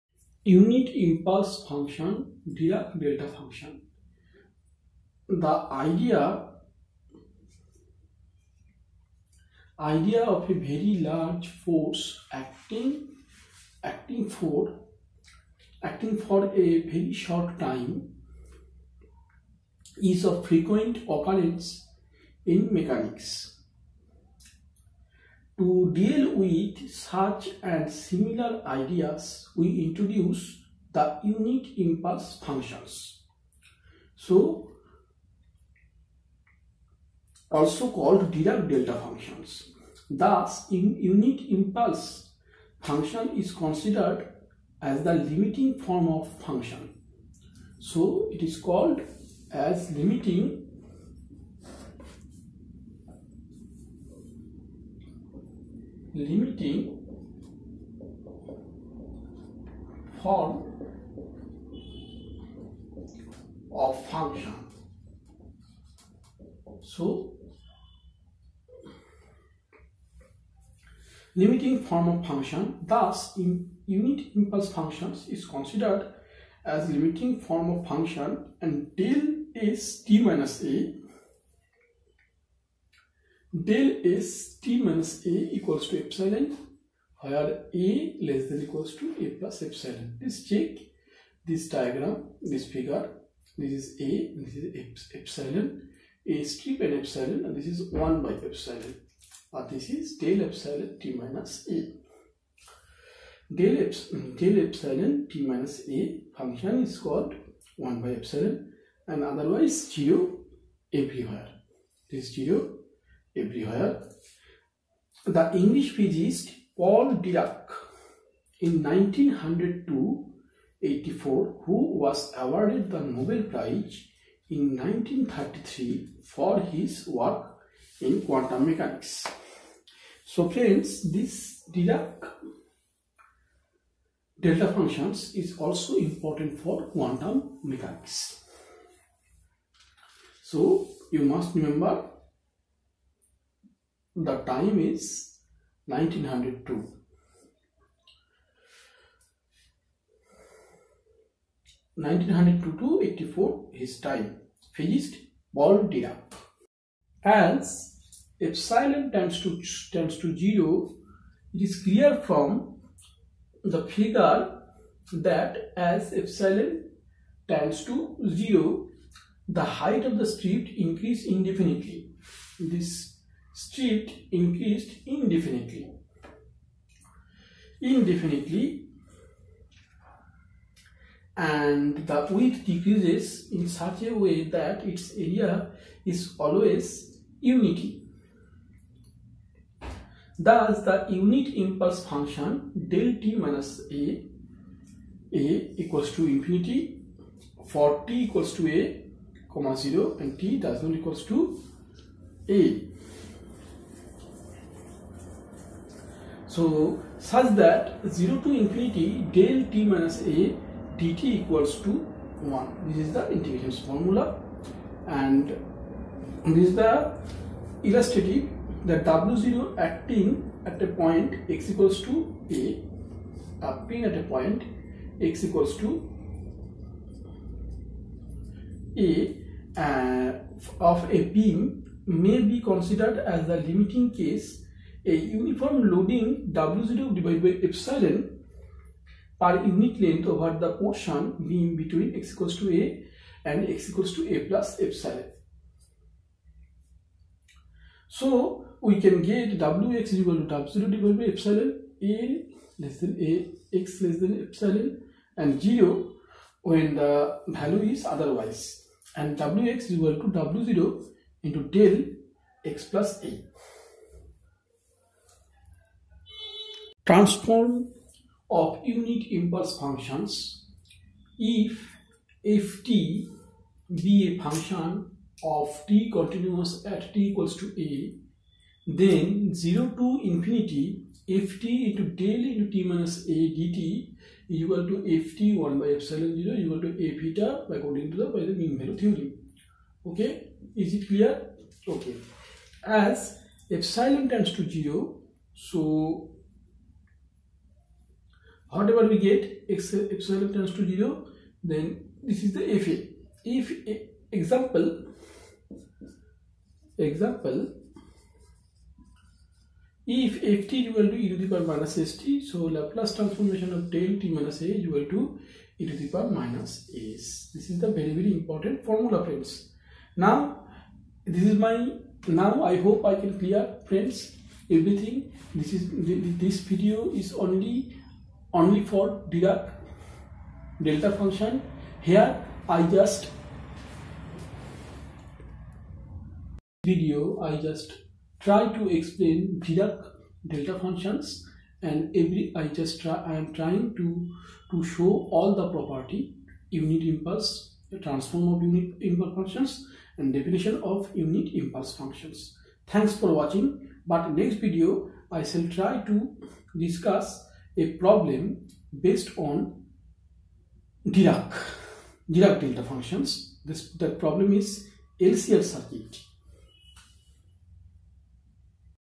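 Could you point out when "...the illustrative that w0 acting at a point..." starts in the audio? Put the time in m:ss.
3:36.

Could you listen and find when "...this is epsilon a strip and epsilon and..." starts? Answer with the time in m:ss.
1:34.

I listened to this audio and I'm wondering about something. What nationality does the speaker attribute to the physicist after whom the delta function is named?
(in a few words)
English.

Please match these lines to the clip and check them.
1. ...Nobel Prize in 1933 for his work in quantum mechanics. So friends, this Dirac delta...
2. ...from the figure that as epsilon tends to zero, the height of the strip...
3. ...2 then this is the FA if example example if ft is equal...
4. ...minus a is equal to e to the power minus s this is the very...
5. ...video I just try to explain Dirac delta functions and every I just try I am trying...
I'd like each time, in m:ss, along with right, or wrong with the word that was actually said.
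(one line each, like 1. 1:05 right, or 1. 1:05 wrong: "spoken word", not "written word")
1. 2:02 right
2. 2:42 right
3. 5:00 wrong: "0", not "2"
4. 5:14 right
5. 5:36 right.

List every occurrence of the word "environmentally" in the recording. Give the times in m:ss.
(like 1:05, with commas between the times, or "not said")
not said.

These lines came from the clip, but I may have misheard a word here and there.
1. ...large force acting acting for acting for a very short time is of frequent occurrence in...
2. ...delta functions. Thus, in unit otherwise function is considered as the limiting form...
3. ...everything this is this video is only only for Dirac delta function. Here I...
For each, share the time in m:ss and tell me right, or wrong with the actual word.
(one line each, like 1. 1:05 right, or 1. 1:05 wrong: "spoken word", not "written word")
1. 0:10 right
2. 0:38 wrong: "impulse", not "otherwise"
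3. 5:24 right.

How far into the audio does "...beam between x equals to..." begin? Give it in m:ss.
4:01.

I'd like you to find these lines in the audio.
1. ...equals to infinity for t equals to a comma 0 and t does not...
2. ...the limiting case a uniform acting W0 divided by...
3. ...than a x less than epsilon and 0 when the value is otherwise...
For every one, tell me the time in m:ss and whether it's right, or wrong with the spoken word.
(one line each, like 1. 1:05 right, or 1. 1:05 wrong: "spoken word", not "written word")
1. 3:15 right
2. 3:53 wrong: "loading", not "acting"
3. 4:12 right.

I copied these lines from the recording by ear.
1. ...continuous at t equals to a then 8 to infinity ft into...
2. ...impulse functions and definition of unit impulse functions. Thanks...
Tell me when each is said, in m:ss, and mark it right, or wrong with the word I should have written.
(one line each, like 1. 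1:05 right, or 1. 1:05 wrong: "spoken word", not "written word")
1. 4:36 wrong: "0", not "8"
2. 5:49 right.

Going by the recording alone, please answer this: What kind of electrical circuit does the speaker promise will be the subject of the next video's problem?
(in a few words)
LCL circuit.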